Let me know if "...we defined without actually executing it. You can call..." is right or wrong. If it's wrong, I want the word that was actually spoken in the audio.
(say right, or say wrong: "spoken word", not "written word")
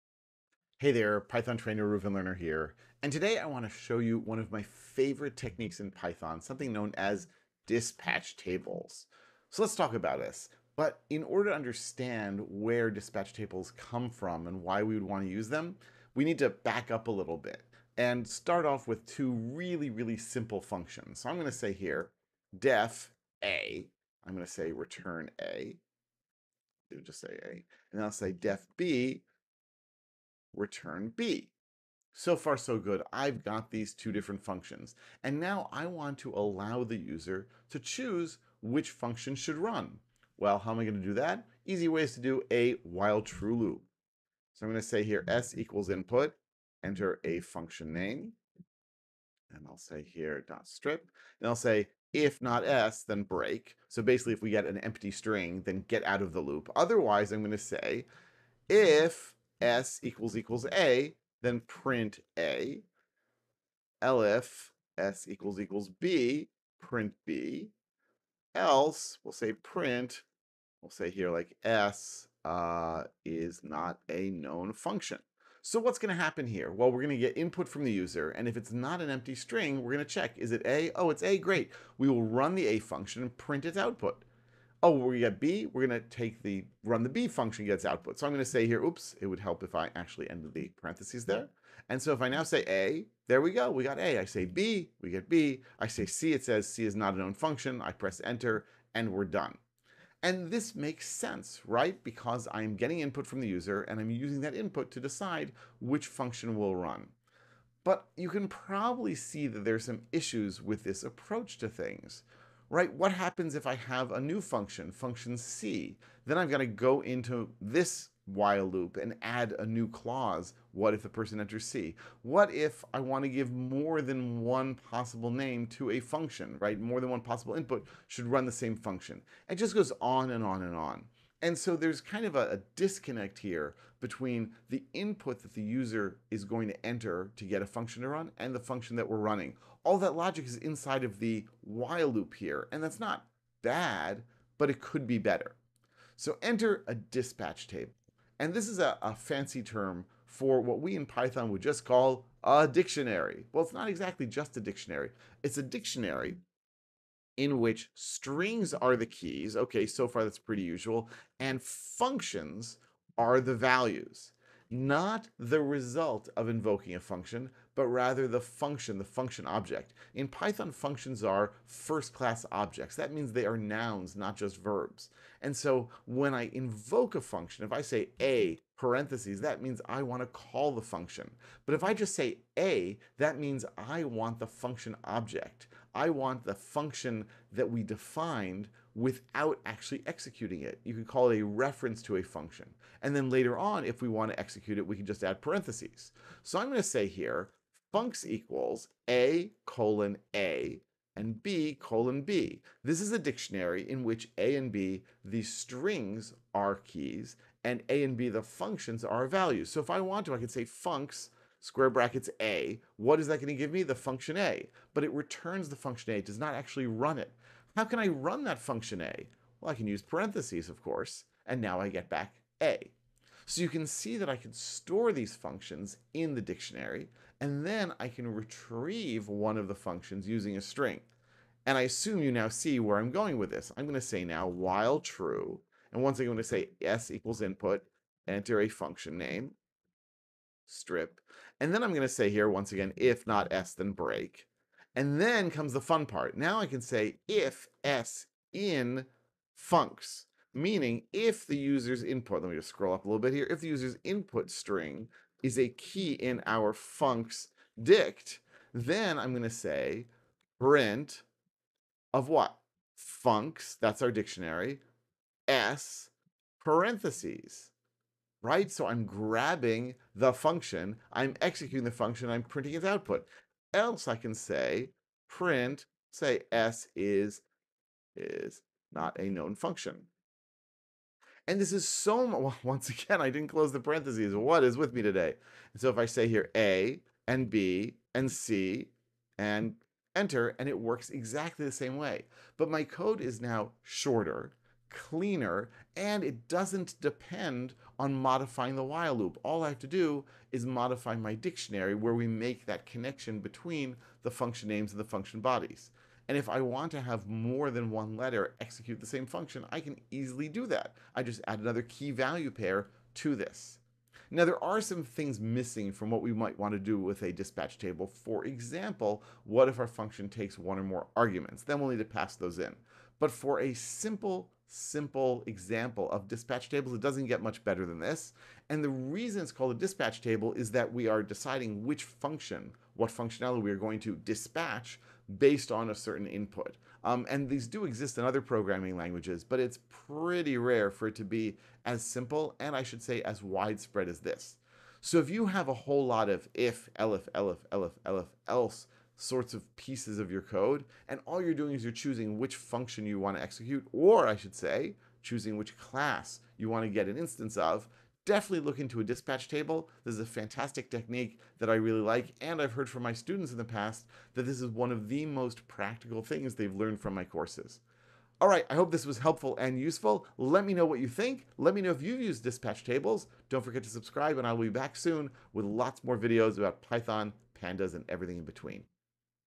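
right.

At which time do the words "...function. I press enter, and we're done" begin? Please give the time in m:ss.
1:37.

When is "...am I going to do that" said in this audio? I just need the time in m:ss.
0:40.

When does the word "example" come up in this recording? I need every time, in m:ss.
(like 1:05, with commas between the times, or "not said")
5:18, 5:25.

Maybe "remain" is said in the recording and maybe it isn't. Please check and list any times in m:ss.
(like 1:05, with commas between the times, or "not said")
not said.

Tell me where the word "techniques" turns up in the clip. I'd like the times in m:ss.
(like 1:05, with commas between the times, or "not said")
0:05, 6:00.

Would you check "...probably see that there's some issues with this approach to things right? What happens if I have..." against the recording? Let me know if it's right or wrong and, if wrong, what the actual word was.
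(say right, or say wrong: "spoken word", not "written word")
right.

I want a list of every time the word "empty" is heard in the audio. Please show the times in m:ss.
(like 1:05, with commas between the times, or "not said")
0:54, 1:19.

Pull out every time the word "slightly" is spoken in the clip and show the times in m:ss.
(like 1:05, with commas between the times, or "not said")
not said.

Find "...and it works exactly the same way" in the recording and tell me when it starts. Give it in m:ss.
4:50.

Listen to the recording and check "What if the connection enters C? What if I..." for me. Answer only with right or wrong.
wrong.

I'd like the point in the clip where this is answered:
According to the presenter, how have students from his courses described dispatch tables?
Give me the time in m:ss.
6:05.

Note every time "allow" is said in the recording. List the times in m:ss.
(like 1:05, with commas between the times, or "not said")
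0:36.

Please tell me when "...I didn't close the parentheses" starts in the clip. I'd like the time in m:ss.
4:43.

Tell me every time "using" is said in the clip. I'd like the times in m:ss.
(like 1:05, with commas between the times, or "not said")
1:44, 3:50.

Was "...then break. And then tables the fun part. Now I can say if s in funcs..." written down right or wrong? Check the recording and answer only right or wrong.
wrong.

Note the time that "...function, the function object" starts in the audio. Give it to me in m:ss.
2:48.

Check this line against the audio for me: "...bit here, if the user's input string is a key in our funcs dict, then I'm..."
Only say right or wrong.
right.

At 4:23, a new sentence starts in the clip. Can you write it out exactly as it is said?
Funcs, that's our dictionary, s parentheses, right?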